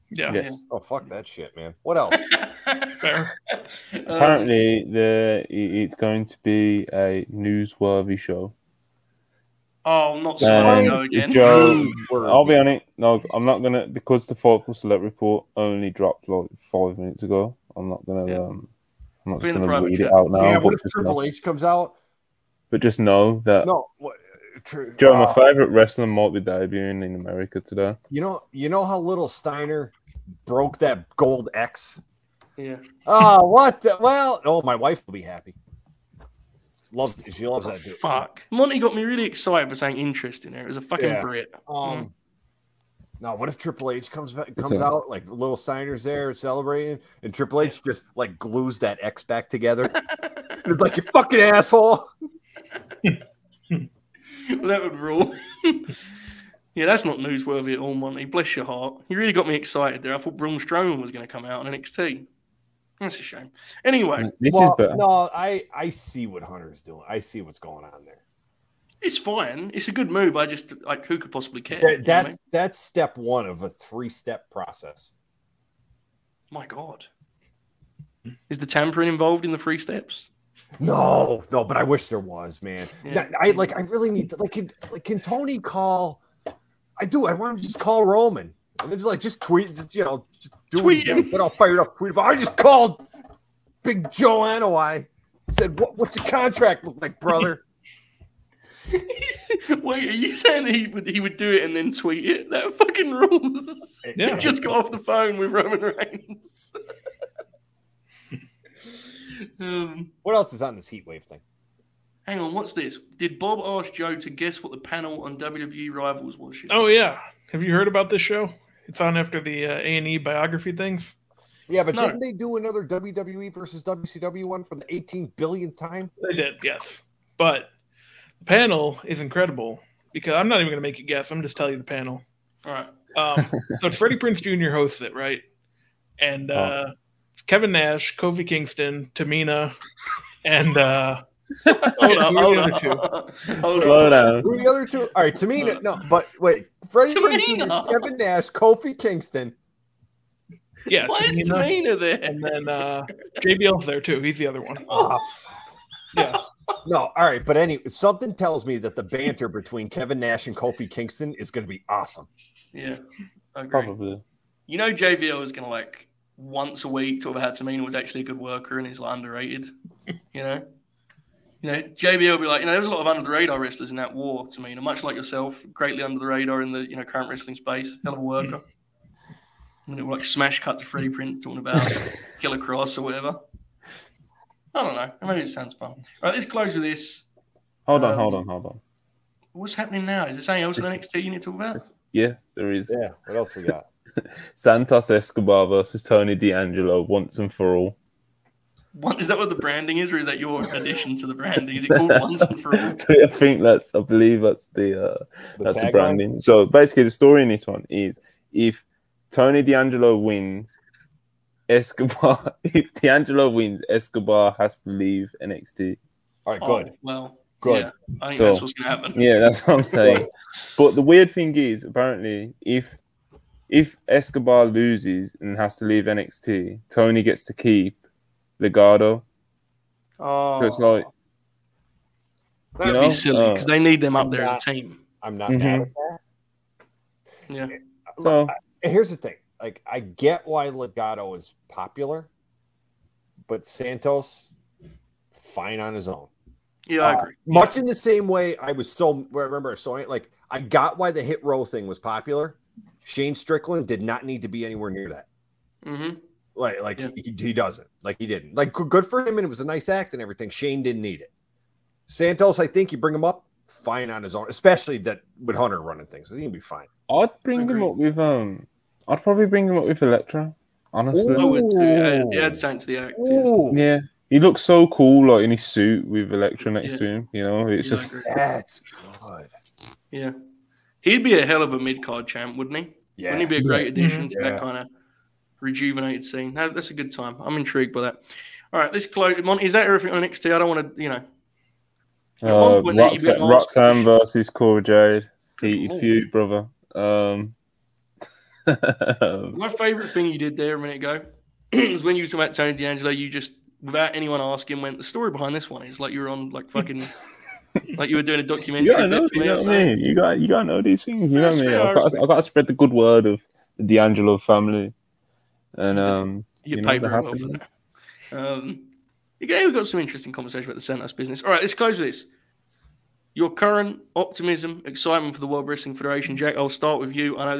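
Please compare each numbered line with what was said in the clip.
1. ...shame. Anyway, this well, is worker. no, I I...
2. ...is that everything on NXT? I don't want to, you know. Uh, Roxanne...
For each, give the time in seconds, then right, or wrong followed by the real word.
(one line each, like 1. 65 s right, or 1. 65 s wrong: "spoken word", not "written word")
1. 63 s wrong: "better", not "worker"
2. 289 s right.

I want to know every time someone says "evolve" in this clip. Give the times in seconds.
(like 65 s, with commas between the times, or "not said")
not said.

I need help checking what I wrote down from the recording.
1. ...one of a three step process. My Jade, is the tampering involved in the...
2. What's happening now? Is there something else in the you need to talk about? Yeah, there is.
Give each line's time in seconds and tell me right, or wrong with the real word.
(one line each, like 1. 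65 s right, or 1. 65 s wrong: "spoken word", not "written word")
1. 73 s wrong: "God", not "Jade"
2. 189 s right.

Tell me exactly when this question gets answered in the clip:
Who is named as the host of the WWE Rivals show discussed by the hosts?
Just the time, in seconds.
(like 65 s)
133 s.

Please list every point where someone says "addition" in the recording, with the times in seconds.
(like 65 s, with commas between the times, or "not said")
200 s, 283 s.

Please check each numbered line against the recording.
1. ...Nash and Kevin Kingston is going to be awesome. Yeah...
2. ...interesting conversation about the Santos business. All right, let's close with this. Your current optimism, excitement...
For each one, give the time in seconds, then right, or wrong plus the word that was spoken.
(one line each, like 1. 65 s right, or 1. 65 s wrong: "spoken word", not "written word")
1. 160 s wrong: "Kofi", not "Kevin"
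2. 320 s right.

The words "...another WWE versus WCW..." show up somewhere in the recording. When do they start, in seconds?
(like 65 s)
122 s.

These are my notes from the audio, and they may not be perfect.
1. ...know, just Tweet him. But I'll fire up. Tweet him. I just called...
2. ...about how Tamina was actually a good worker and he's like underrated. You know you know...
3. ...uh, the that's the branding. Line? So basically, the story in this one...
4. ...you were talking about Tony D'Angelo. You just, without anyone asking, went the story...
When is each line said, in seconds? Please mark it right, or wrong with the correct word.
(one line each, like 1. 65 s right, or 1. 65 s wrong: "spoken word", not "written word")
1. 90 s right
2. 167 s right
3. 205 s right
4. 302 s right.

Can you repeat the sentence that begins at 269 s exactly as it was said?
I'd probably bring him up with Electra.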